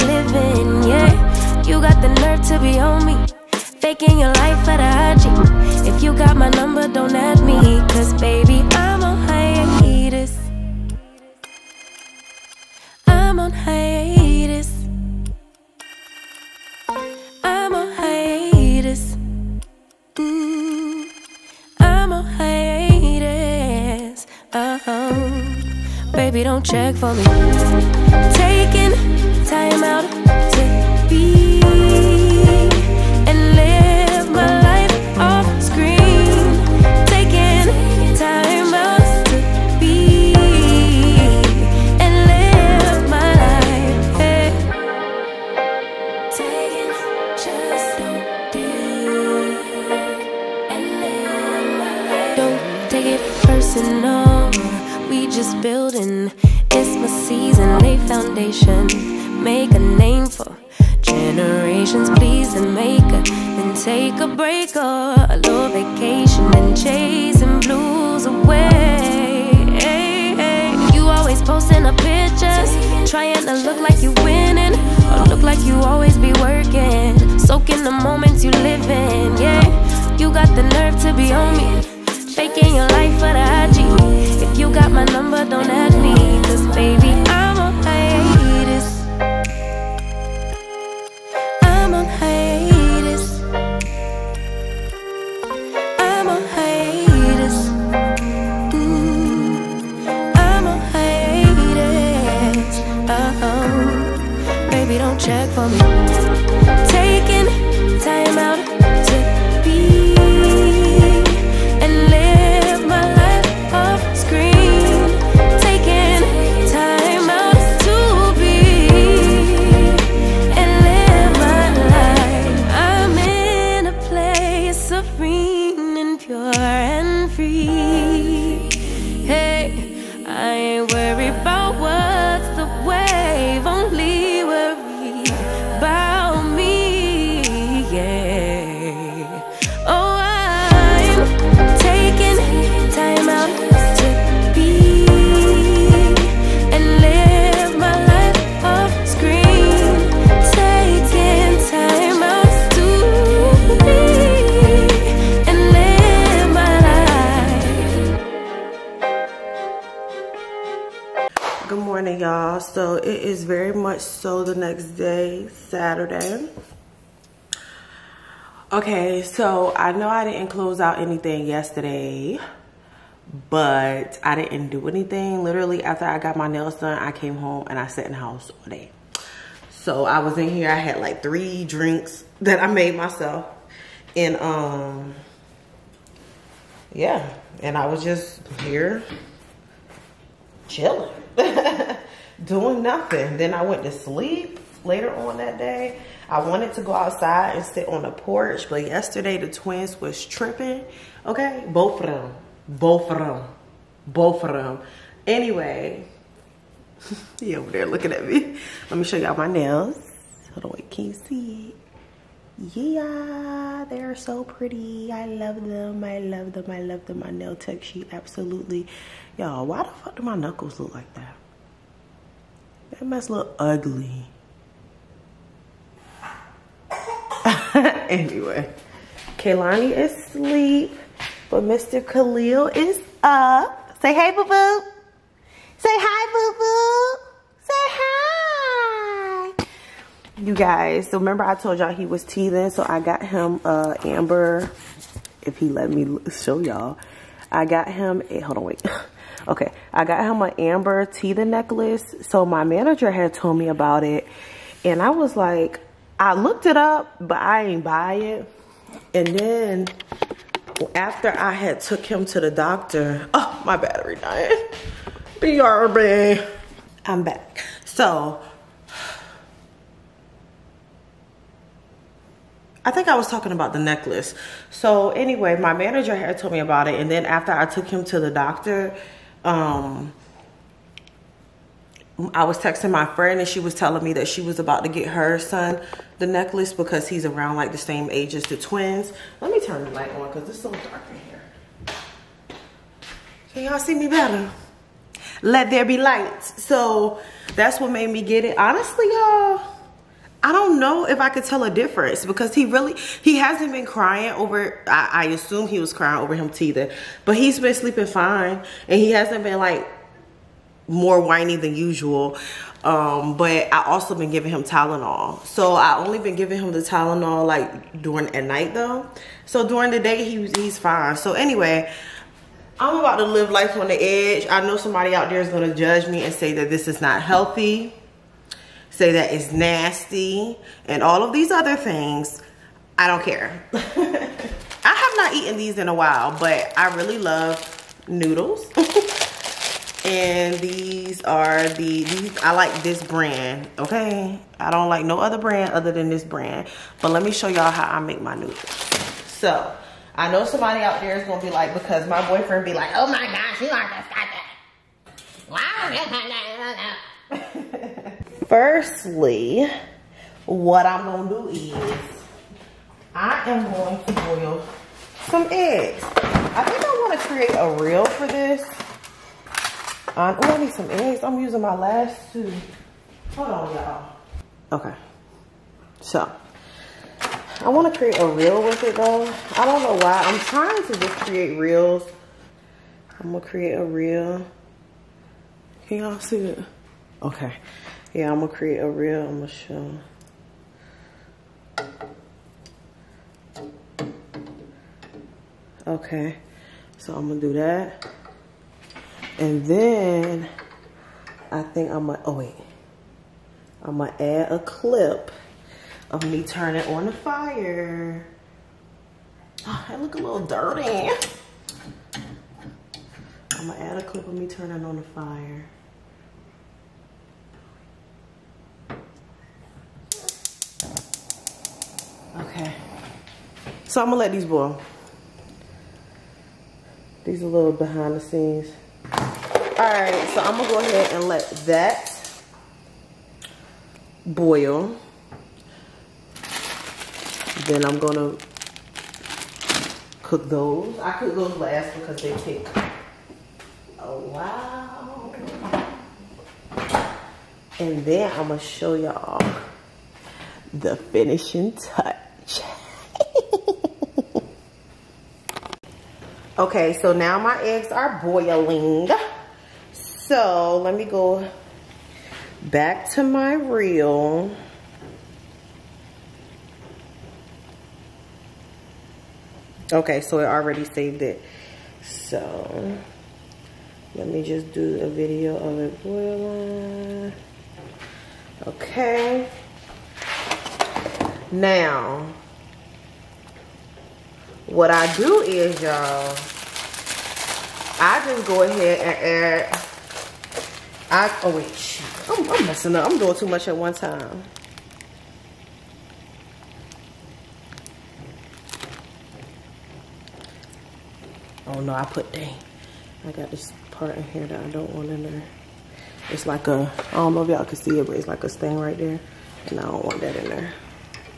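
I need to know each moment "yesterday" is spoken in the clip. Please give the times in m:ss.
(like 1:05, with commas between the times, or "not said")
2:51, 3:18.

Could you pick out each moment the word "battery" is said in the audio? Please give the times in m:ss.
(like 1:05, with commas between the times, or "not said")
4:23.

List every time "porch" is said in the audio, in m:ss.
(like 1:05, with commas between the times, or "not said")
3:18.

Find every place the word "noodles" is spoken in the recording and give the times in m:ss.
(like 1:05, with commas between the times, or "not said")
5:38, 5:48.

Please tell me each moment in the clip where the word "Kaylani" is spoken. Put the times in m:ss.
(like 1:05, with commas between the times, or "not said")
3:49.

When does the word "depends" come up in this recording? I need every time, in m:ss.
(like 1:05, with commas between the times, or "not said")
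not said.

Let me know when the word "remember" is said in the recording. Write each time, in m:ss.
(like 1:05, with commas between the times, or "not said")
4:01.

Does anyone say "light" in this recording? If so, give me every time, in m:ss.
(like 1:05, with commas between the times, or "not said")
4:49, 4:55.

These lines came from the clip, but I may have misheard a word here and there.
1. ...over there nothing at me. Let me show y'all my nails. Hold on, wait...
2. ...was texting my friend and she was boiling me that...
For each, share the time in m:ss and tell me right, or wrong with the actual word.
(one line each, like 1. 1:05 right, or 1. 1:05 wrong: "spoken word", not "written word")
1. 3:27 wrong: "looking", not "nothing"
2. 4:42 wrong: "telling", not "boiling".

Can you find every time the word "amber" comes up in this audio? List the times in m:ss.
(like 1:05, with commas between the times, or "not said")
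4:04, 4:10.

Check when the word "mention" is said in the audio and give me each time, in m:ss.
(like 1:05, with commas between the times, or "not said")
not said.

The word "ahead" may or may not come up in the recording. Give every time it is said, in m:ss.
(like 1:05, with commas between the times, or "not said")
7:10, 8:08.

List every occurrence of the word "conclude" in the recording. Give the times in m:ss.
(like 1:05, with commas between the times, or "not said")
not said.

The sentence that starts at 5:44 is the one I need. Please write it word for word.
I don't like no other brand other than this brand.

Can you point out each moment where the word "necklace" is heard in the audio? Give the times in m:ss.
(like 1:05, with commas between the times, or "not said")
4:11, 4:33, 4:46.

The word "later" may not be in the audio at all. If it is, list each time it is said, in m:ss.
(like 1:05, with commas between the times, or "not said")
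3:14.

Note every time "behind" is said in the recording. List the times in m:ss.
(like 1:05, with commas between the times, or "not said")
7:07.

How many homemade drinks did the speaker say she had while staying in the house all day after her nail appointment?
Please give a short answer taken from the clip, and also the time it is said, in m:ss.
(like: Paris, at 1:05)
3, at 3:01.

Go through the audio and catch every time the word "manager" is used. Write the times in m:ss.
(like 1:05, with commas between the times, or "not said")
4:12, 4:35.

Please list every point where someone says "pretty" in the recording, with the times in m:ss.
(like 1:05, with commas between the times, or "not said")
3:34.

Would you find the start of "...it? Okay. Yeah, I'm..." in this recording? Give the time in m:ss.
6:26.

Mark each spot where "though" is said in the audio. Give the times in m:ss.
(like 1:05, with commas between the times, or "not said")
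5:18, 6:18.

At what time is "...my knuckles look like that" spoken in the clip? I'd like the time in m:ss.
3:40.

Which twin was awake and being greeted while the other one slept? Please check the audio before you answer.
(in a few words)
Khalil.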